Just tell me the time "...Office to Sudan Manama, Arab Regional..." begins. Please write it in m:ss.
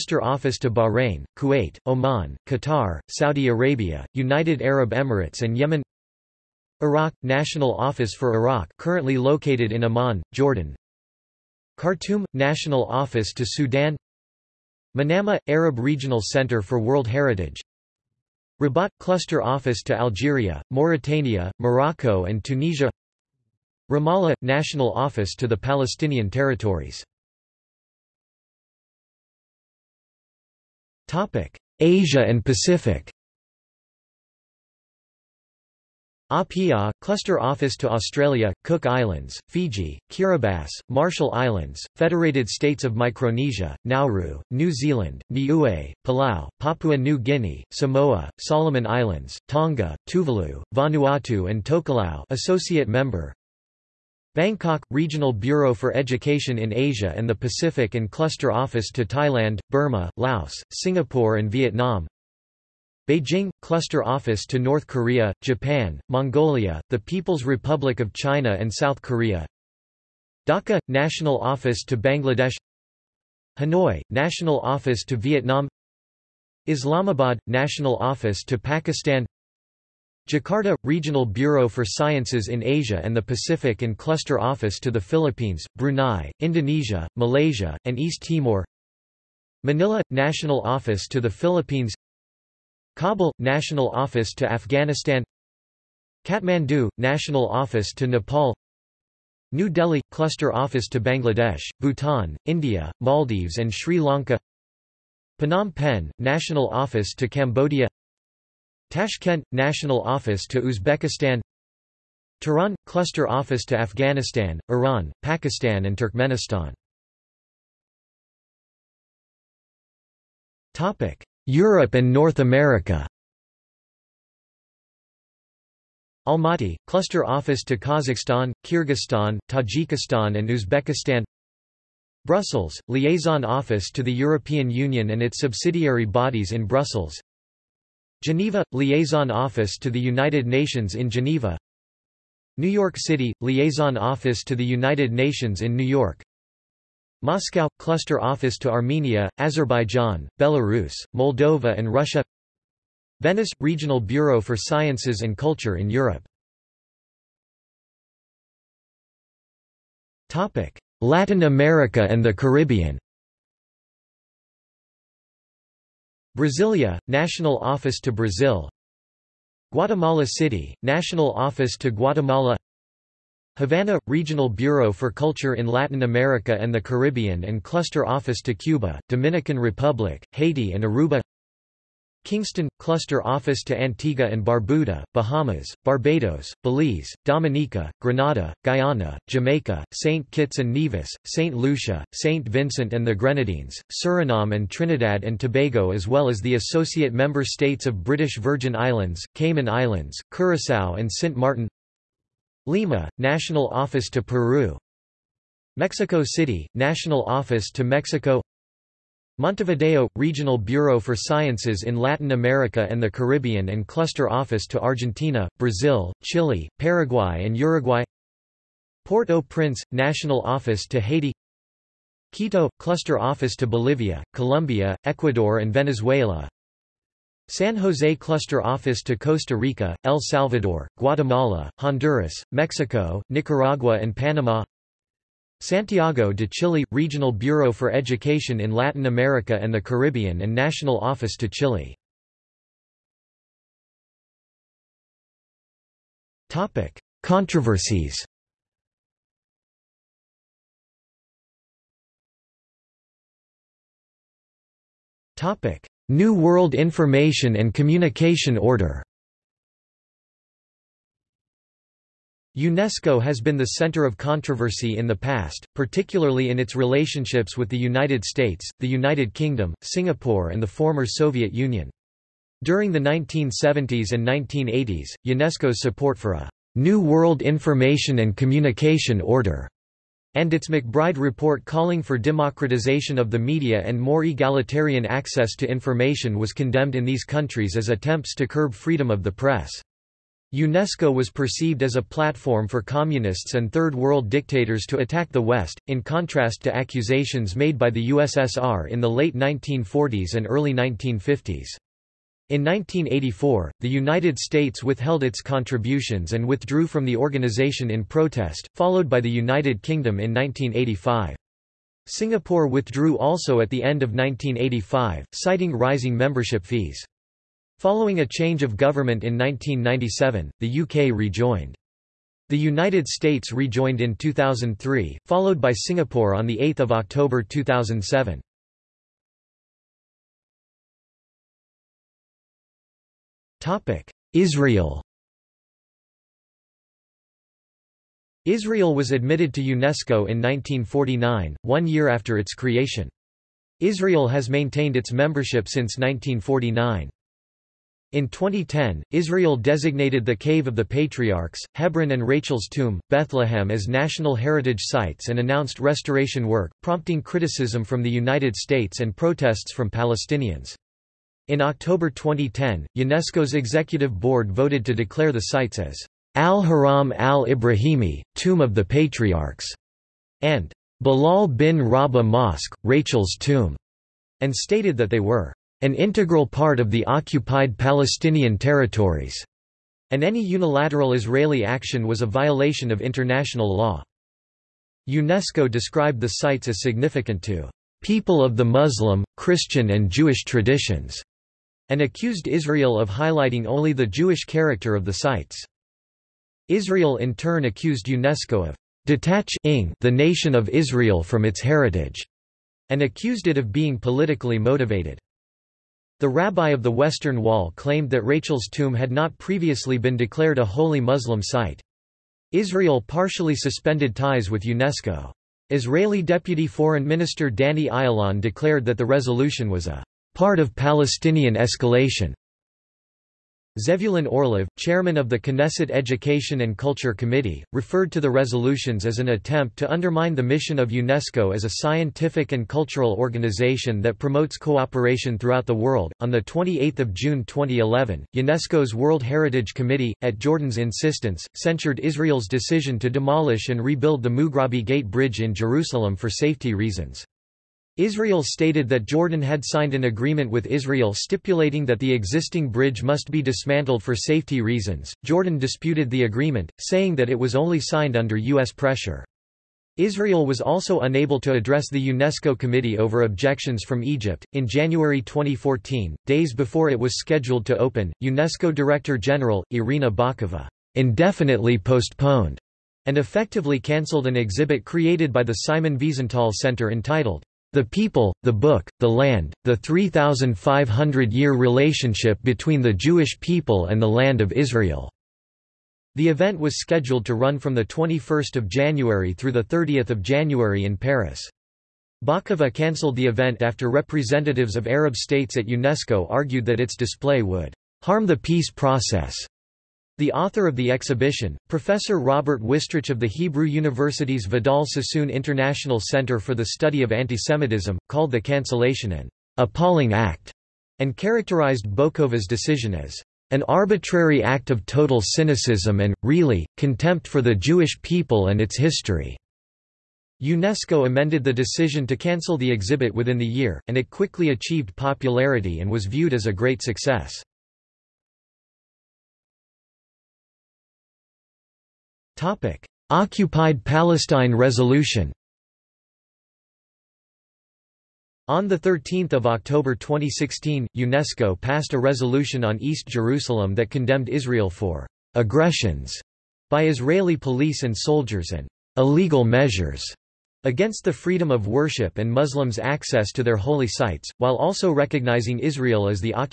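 0:12.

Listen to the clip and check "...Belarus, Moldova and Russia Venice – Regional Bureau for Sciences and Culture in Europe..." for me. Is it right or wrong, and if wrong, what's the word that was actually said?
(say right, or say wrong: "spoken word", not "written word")
right.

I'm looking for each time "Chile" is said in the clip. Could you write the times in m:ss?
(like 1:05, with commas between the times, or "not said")
3:36, 3:56, 4:01.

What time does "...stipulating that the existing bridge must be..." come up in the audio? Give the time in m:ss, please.
7:31.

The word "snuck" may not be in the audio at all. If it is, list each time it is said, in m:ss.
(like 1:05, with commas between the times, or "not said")
not said.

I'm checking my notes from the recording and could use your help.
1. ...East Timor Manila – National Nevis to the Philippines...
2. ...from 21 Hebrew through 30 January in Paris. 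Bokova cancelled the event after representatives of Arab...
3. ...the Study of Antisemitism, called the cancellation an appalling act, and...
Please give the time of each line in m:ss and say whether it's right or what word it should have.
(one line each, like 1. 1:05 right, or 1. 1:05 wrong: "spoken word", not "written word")
1. 1:27 wrong: "Office", not "Nevis"
2. 8:07 wrong: "January", not "Hebrew"
3. 8:26 right.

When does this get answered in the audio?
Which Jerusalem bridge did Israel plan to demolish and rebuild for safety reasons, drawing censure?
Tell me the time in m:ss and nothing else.
7:24.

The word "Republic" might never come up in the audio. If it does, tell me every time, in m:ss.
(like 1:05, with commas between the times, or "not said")
1:07, 2:59.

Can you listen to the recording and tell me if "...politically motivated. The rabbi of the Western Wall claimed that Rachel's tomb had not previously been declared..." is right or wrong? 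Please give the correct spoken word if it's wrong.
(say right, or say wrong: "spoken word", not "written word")
right.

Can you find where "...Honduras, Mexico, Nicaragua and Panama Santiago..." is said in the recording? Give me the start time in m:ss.
3:51.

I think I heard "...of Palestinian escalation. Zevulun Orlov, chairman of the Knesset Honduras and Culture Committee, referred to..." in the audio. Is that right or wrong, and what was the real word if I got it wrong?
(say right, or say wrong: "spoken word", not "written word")
wrong: "Education", not "Honduras".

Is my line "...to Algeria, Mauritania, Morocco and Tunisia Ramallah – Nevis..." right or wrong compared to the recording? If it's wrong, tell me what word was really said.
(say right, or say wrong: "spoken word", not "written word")
wrong: "National", not "Nevis".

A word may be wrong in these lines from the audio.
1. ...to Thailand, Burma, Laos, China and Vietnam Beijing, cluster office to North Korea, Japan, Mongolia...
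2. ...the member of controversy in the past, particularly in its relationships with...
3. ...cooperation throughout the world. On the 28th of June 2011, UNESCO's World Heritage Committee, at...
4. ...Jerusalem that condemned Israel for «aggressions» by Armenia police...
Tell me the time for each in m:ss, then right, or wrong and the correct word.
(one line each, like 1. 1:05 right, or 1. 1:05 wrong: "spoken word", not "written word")
1. 0:58 wrong: "Singapore", not "China"
2. 4:23 wrong: "center", not "member"
3. 7:14 right
4. 9:03 wrong: "Israeli", not "Armenia".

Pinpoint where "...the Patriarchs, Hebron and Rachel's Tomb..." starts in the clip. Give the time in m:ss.
5:50.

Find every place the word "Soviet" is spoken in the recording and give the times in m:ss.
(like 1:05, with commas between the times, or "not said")
4:31.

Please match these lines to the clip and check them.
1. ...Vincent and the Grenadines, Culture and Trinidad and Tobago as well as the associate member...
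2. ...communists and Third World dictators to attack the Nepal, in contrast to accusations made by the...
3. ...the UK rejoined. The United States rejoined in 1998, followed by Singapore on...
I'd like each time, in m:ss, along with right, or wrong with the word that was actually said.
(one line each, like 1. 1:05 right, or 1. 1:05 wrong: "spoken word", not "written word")
1. 3:12 wrong: "Suriname", not "Culture"
2. 4:52 wrong: "West", not "Nepal"
3. 5:20 wrong: "2003", not "1998".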